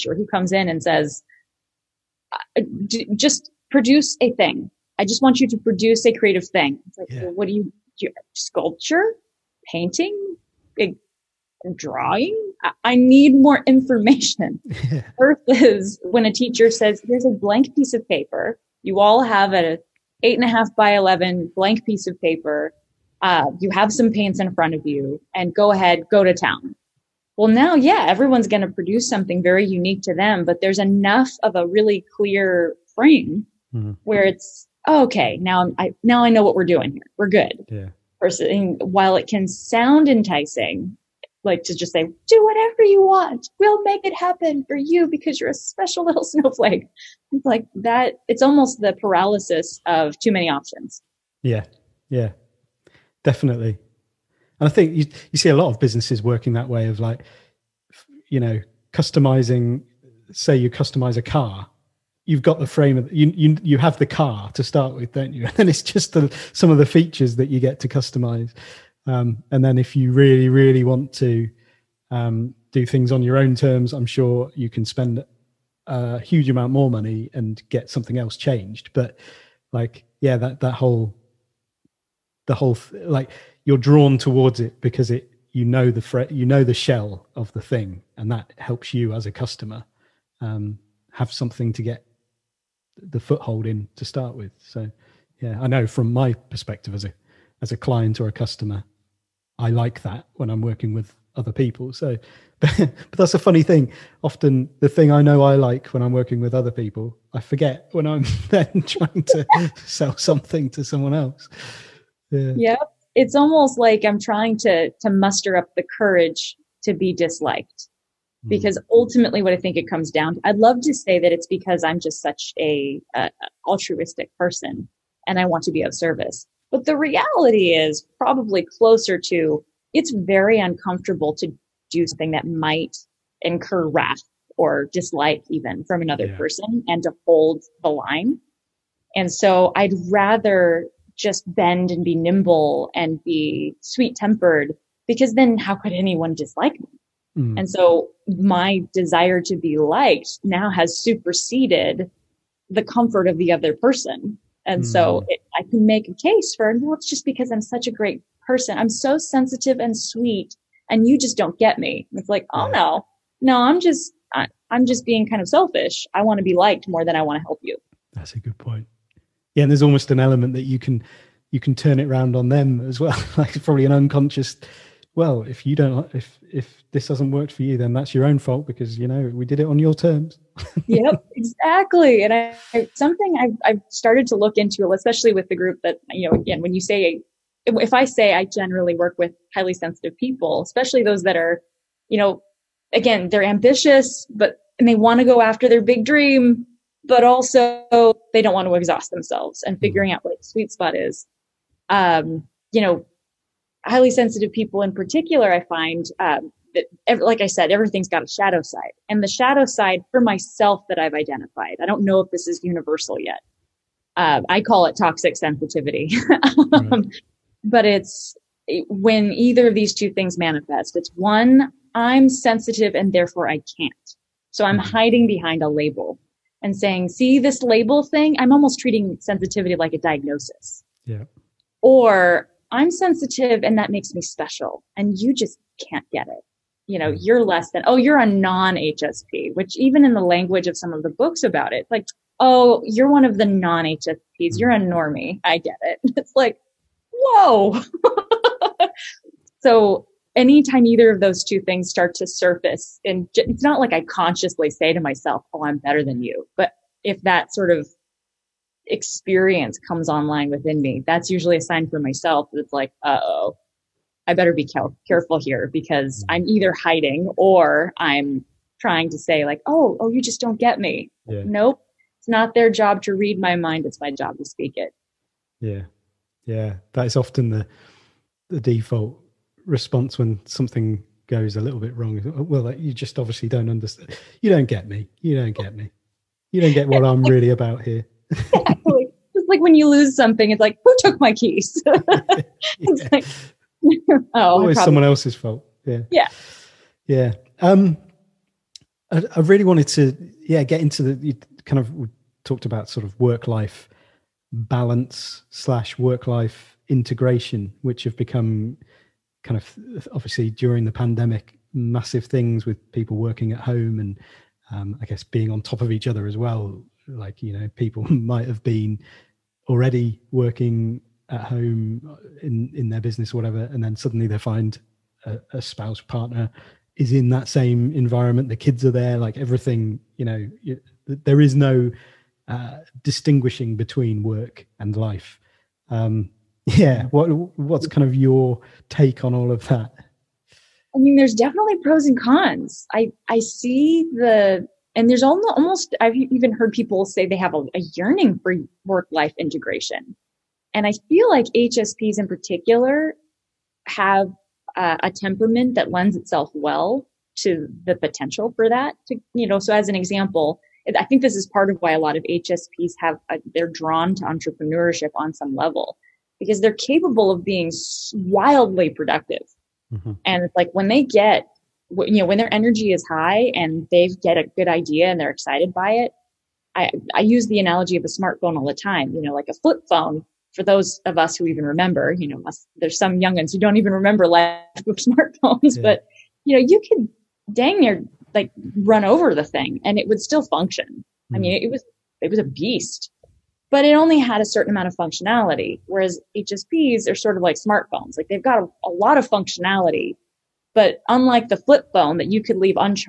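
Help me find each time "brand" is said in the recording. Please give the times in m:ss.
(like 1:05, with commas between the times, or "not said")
not said.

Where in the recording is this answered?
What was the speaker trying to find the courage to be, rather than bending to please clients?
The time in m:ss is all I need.
1:56.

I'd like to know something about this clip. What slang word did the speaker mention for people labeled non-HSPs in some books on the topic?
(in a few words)
Normie.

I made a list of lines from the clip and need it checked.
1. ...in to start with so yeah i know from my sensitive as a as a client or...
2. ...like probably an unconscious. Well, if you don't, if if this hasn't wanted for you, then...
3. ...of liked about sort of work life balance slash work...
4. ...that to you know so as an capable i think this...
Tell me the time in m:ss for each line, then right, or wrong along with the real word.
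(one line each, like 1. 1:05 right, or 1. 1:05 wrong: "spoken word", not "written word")
1. 1:33 wrong: "perspective", not "sensitive"
2. 2:53 wrong: "worked", not "wanted"
3. 5:01 wrong: "talked", not "liked"
4. 5:58 wrong: "example", not "capable".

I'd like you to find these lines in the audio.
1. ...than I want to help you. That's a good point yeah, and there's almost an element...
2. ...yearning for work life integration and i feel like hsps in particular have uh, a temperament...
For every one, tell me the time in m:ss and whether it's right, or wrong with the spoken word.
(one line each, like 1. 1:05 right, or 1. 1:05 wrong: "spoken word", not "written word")
1. 2:47 right
2. 5:47 right.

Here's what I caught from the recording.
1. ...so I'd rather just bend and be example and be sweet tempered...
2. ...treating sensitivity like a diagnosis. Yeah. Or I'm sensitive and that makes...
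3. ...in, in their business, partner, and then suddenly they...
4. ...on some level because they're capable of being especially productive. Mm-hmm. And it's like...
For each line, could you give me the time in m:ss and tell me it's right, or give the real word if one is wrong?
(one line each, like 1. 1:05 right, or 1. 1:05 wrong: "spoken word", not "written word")
1. 2:19 wrong: "nimble", not "example"
2. 3:48 right
3. 5:22 wrong: "whatever", not "partner"
4. 6:05 wrong: "wildly", not "especially".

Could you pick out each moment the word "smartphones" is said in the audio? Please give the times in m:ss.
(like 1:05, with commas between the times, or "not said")
6:18, 6:24, 6:37.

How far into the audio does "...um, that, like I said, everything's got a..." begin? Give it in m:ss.
3:26.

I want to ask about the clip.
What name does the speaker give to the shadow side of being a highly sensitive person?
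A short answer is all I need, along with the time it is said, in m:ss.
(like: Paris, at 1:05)
Toxic sensitivity, at 3:34.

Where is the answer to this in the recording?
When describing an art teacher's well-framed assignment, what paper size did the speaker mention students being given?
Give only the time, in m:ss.
0:20.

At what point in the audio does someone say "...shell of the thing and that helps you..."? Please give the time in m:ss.
1:26.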